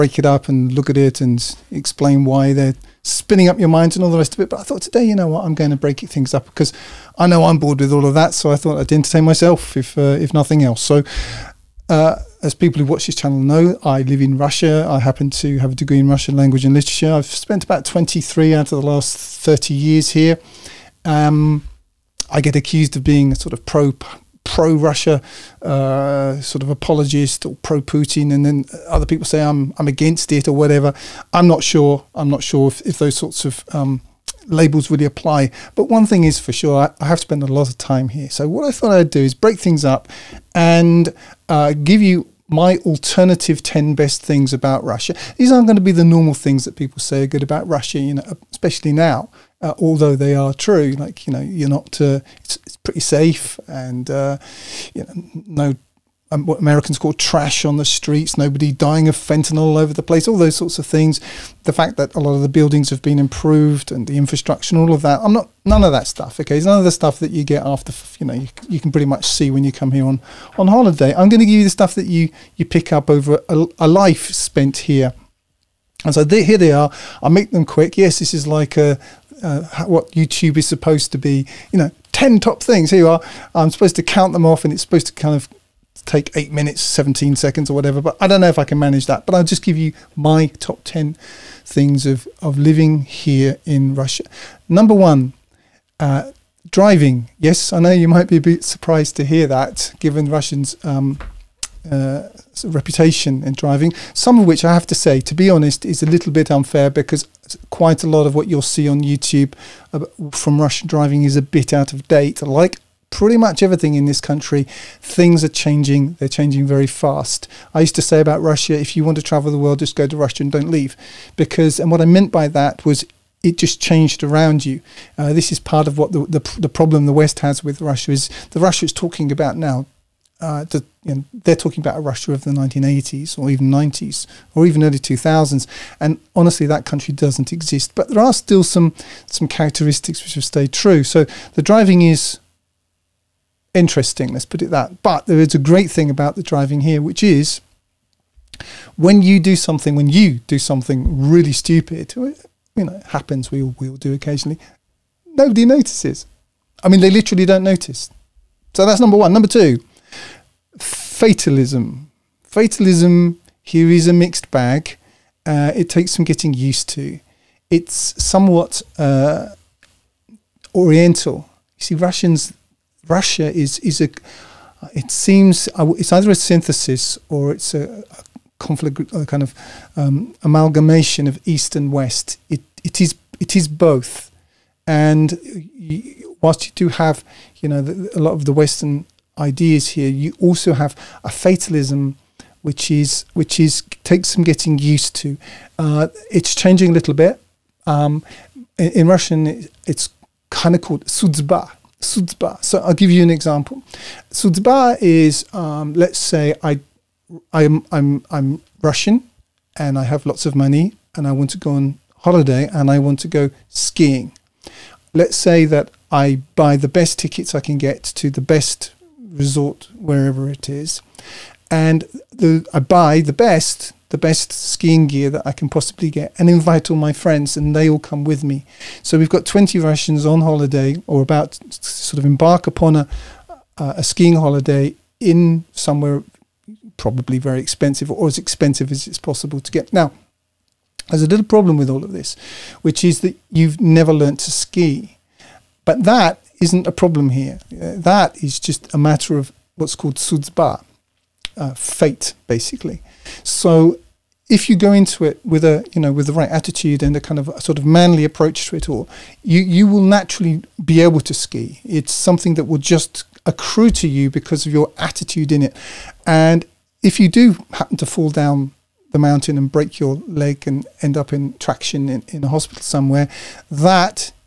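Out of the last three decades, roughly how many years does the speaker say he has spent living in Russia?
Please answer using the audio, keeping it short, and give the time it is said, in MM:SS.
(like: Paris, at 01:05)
23, at 00:17.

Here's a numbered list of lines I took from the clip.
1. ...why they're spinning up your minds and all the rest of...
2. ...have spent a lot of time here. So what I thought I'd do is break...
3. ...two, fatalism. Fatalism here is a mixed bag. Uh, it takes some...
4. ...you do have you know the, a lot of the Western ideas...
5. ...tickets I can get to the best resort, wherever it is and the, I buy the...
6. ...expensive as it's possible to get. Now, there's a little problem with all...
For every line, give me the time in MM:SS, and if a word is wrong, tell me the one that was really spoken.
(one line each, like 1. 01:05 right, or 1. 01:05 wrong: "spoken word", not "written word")
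1. 00:02 right
2. 00:37 right
3. 02:39 right
4. 03:06 right
5. 03:37 right
6. 03:58 right.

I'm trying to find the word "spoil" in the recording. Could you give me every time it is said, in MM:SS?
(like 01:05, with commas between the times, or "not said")
not said.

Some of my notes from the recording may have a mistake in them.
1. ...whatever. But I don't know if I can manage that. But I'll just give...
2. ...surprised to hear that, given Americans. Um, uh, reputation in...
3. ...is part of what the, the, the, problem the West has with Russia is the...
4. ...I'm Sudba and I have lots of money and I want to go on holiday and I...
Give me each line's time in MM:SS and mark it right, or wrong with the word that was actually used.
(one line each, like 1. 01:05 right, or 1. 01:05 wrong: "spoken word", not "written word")
1. 01:27 right
2. 01:38 wrong: "Russians", not "Americans"
3. 02:05 right
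4. 03:28 wrong: "Russian", not "Sudba".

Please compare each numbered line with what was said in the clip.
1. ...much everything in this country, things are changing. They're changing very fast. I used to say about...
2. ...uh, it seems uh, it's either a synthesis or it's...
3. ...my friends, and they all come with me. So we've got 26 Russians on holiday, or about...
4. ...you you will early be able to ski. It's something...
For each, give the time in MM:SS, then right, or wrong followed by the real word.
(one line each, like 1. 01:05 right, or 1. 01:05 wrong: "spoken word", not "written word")
1. 01:53 right
2. 02:54 right
3. 03:46 wrong: "20", not "26"
4. 04:19 wrong: "naturally", not "early".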